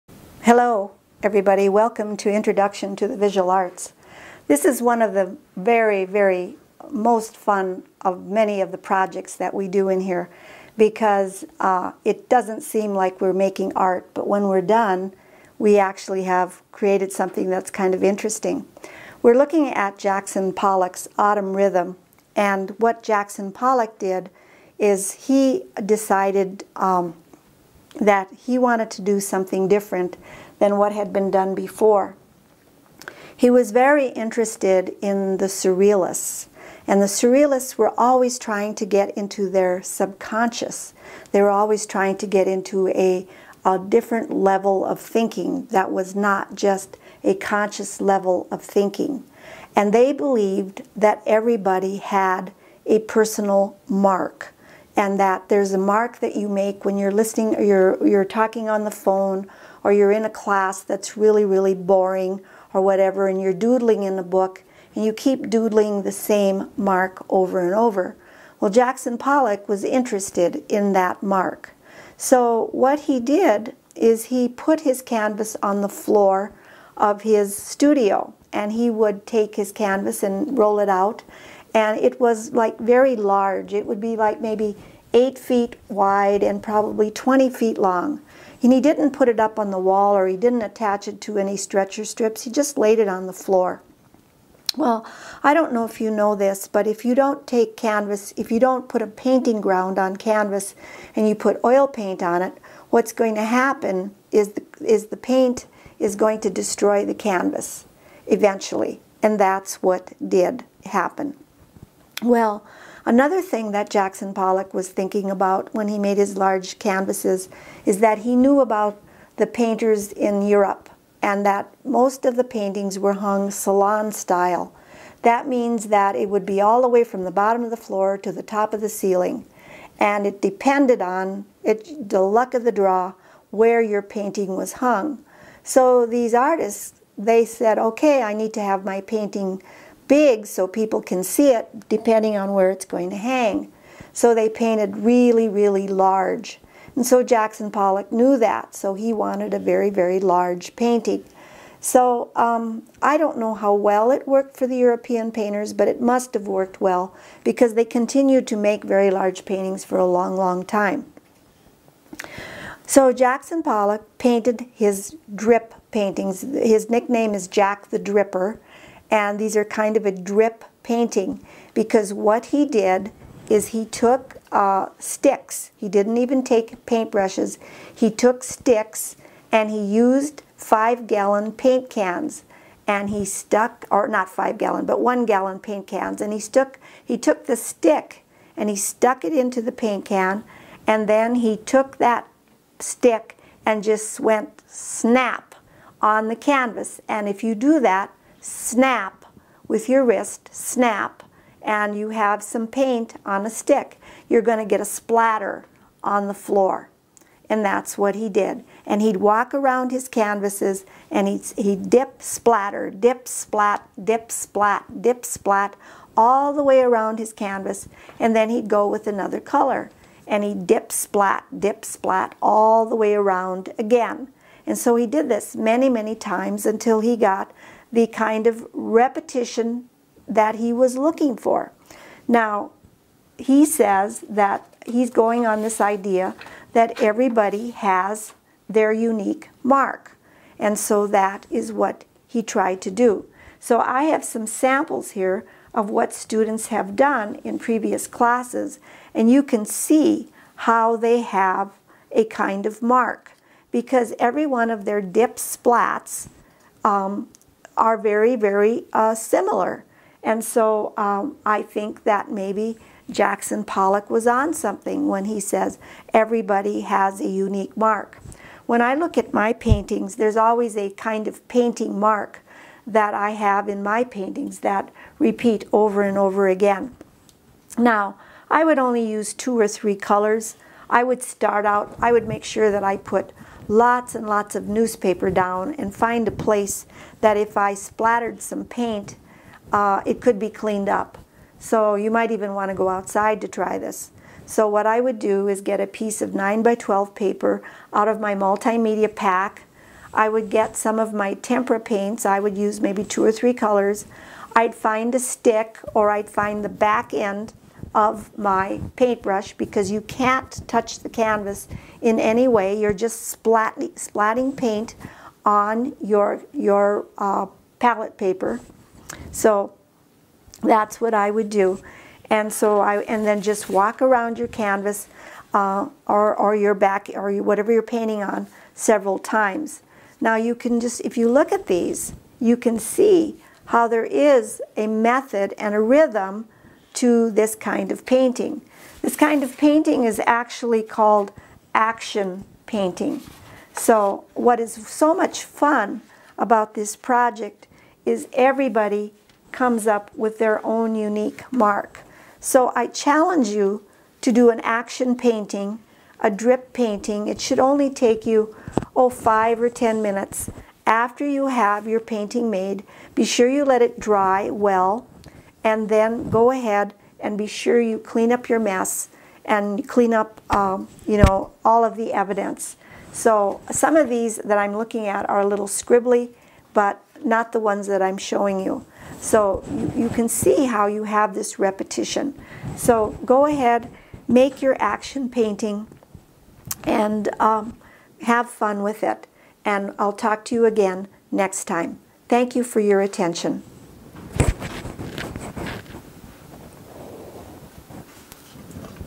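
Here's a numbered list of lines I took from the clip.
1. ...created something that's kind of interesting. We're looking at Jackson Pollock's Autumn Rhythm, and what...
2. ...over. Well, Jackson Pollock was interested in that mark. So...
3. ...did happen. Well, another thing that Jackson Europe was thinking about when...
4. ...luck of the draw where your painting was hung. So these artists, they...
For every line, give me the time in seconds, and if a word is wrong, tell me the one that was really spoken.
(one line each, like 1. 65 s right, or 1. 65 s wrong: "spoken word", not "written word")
1. 16 s right
2. 67 s right
3. 110 s wrong: "Pollock", not "Europe"
4. 132 s right.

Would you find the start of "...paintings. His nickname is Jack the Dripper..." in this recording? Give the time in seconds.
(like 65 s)
165 s.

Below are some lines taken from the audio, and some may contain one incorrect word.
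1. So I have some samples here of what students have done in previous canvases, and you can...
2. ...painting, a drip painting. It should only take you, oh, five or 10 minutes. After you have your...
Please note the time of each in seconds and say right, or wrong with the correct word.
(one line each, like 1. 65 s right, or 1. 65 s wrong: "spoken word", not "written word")
1. 243 s wrong: "classes", not "canvases"
2. 355 s right.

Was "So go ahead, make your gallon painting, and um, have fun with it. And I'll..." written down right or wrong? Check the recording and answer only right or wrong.
wrong.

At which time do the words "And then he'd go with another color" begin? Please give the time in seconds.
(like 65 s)
218 s.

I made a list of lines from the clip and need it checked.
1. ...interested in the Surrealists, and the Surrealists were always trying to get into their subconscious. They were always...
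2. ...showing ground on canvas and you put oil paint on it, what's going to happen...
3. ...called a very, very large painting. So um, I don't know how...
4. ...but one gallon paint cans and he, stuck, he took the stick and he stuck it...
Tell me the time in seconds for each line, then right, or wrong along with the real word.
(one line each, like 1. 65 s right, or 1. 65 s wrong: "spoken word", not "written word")
1. 34 s right
2. 99 s wrong: "painting", not "showing"
3. 149 s wrong: "wanted", not "called"
4. 184 s right.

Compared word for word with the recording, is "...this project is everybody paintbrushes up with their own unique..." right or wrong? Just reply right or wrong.
wrong.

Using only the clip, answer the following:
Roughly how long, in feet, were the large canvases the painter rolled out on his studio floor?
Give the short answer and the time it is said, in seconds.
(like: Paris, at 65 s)
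20 feet, at 87 s.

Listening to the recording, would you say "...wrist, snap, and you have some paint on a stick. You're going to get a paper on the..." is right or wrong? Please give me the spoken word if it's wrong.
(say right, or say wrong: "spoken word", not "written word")
wrong: "splatter", not "paper".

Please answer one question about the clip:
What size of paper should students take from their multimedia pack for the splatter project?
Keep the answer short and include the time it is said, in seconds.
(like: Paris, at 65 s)
9 by 12, at 296 s.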